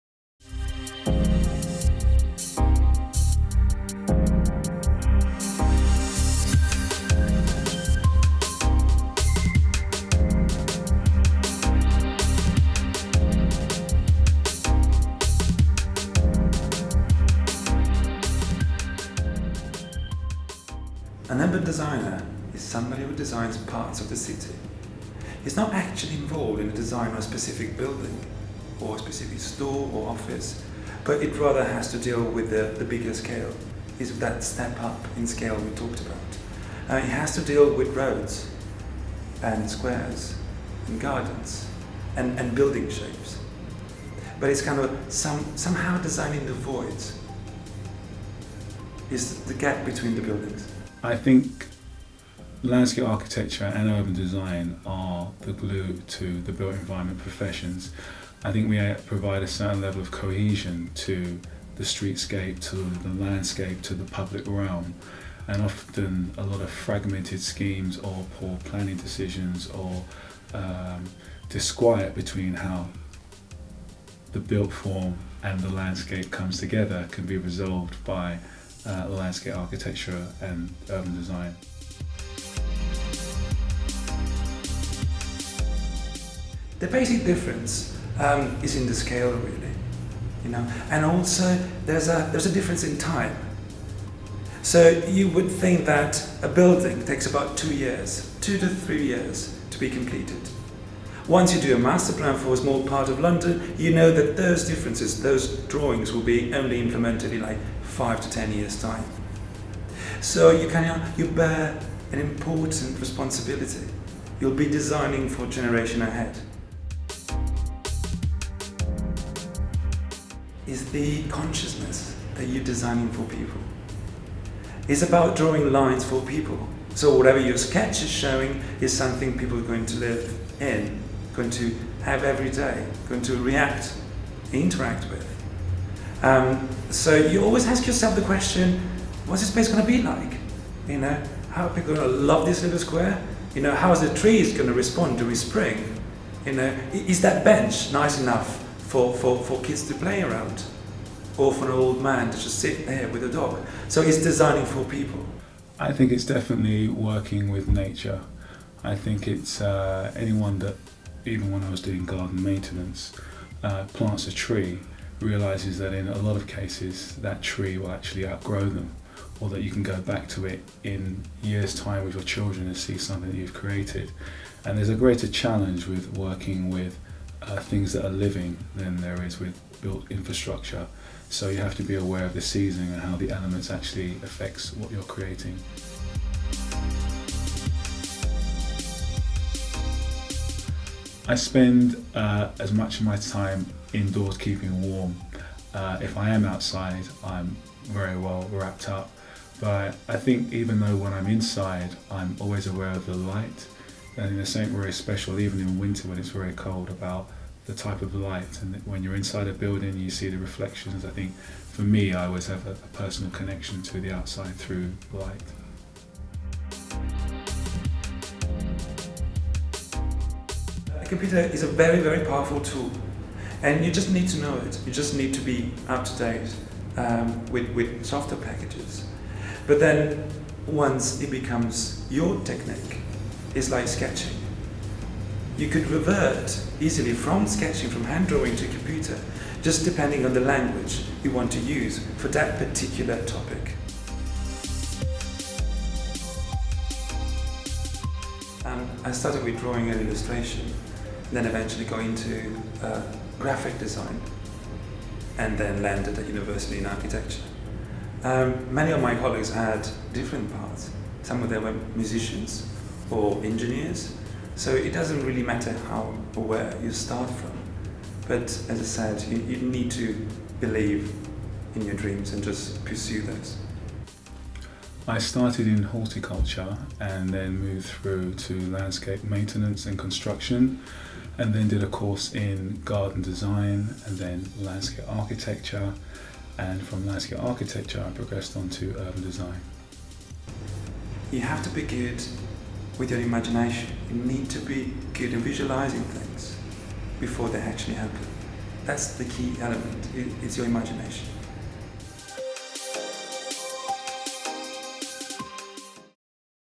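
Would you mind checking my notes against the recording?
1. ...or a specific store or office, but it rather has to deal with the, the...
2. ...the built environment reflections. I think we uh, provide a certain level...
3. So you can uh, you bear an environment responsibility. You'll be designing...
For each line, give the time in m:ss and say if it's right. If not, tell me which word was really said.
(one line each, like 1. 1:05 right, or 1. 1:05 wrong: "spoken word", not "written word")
1. 0:28 right
2. 0:56 wrong: "professions", not "reflections"
3. 1:50 wrong: "important", not "environment".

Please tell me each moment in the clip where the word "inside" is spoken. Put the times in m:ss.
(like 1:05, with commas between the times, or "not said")
3:21, 3:29.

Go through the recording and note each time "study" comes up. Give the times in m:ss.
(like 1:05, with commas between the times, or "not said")
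not said.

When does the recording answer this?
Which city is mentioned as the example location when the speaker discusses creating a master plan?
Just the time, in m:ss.
1:43.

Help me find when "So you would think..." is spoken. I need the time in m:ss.
1:34.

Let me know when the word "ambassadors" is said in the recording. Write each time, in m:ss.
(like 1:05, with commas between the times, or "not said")
not said.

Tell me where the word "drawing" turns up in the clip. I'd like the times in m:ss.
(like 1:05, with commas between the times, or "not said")
1:45, 2:05, 3:58, 4:09.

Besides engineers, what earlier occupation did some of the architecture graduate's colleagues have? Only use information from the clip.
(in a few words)
Musicians.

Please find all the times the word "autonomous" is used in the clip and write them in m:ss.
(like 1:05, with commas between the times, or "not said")
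not said.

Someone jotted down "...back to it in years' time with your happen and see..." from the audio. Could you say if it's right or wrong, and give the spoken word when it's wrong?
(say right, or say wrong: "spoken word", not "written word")
wrong: "children", not "happen".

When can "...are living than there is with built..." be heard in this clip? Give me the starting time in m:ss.
2:58.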